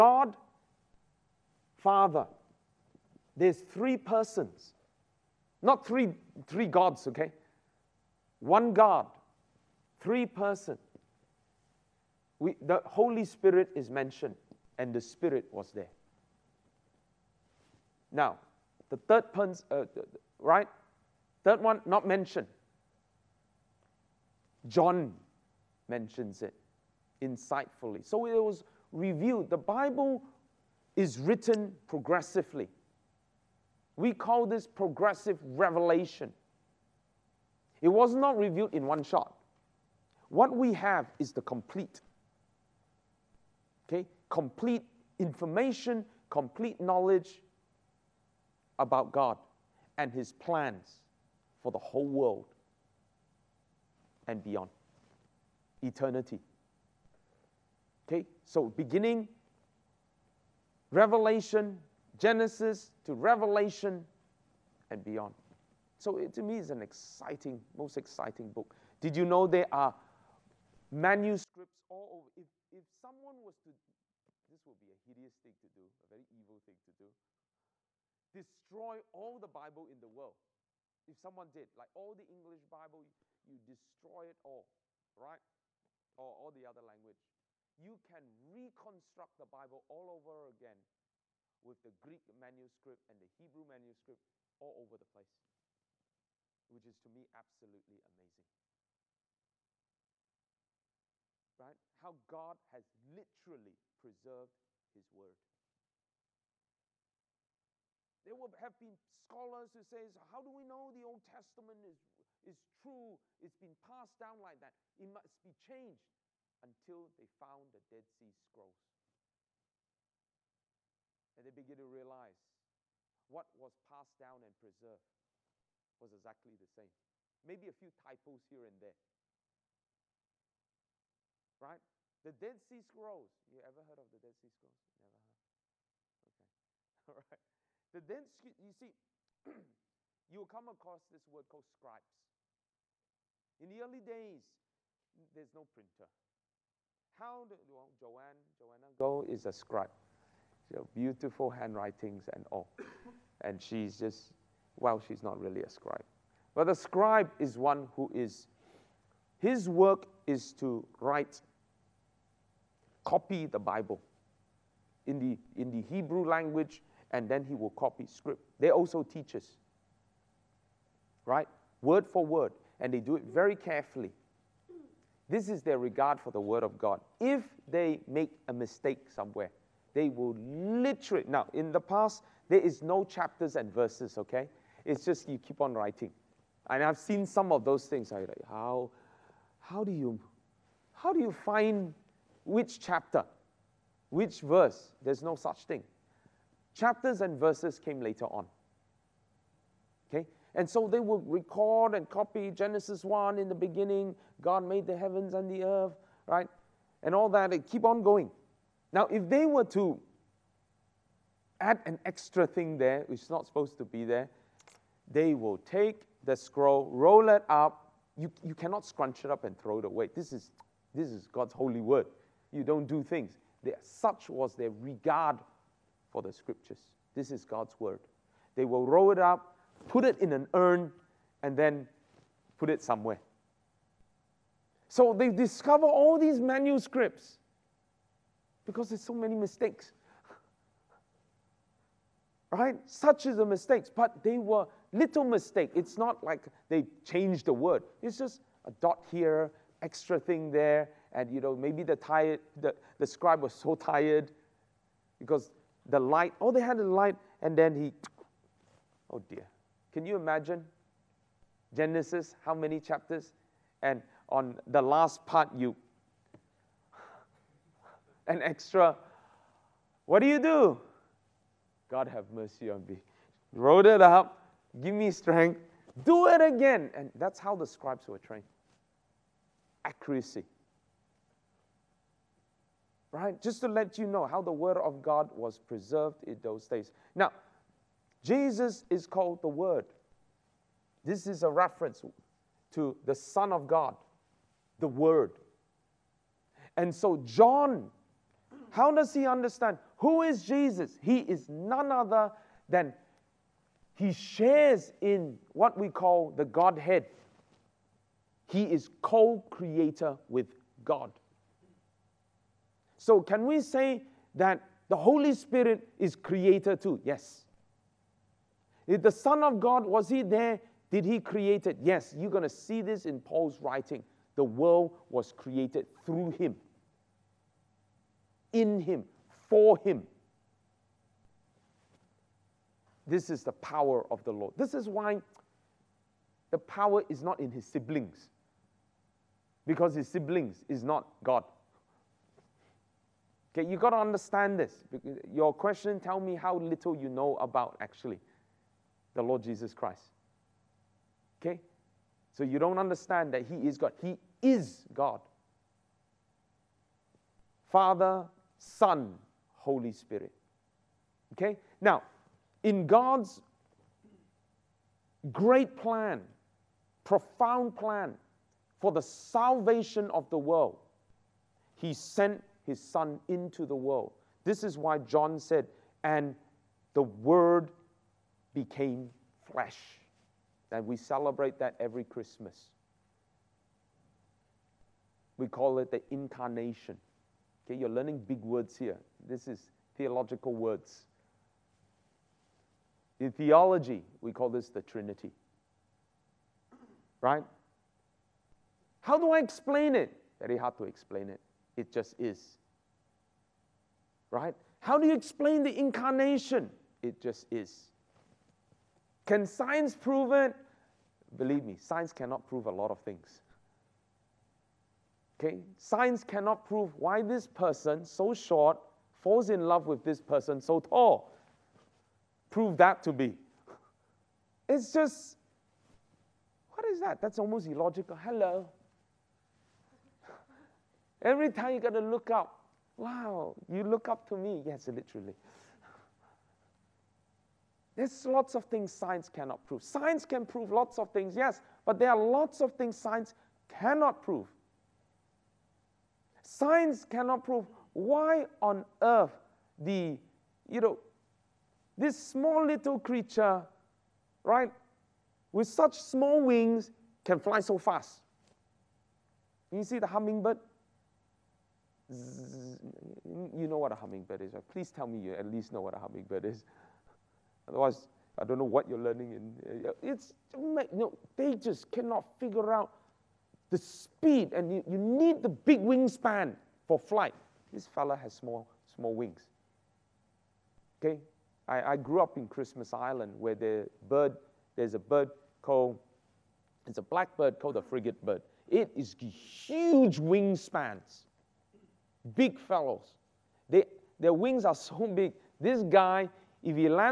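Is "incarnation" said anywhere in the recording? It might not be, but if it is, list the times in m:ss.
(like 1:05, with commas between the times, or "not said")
6:26, 6:45.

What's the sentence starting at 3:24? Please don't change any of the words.
God made the heavens and the earth, right, and all that.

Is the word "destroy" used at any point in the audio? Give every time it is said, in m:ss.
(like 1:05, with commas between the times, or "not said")
1:18, 1:23.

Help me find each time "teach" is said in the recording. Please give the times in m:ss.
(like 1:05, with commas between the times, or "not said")
2:49.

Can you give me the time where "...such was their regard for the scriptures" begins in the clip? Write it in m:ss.
3:43.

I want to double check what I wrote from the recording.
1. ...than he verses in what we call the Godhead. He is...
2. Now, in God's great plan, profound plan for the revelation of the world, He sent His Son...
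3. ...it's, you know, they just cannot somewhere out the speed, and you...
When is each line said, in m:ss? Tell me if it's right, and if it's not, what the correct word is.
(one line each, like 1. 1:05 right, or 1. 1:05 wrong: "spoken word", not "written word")
1. 5:02 wrong: "shares", not "verses"
2. 6:01 wrong: "salvation", not "revelation"
3. 7:50 wrong: "figure", not "somewhere".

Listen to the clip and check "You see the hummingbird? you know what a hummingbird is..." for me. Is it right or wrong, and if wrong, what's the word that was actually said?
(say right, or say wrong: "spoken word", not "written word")
right.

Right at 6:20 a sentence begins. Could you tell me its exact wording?
And we celebrate that every Christmas.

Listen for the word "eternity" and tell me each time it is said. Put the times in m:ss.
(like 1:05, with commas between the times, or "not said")
0:55.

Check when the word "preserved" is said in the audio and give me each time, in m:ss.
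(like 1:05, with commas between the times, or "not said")
1:43, 2:04, 4:45.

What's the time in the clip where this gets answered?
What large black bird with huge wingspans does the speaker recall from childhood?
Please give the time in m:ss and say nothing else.
8:07.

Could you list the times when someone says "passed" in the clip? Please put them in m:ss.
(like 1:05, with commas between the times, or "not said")
1:53, 2:03.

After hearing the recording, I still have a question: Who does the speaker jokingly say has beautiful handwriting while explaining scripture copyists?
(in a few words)
Joanna.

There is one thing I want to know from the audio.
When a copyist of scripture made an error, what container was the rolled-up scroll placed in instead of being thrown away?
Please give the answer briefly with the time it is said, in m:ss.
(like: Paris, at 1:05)
an urn, at 3:50.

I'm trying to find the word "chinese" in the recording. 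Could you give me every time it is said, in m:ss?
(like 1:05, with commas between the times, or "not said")
not said.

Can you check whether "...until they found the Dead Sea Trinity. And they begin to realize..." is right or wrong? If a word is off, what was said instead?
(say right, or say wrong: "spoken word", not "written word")
wrong: "Scrolls", not "Trinity".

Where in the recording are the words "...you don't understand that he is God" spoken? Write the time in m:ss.
5:52.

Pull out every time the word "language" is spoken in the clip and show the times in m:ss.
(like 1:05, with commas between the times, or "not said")
1:26, 2:46.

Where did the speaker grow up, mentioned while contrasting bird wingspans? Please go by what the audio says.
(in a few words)
Christmas Island.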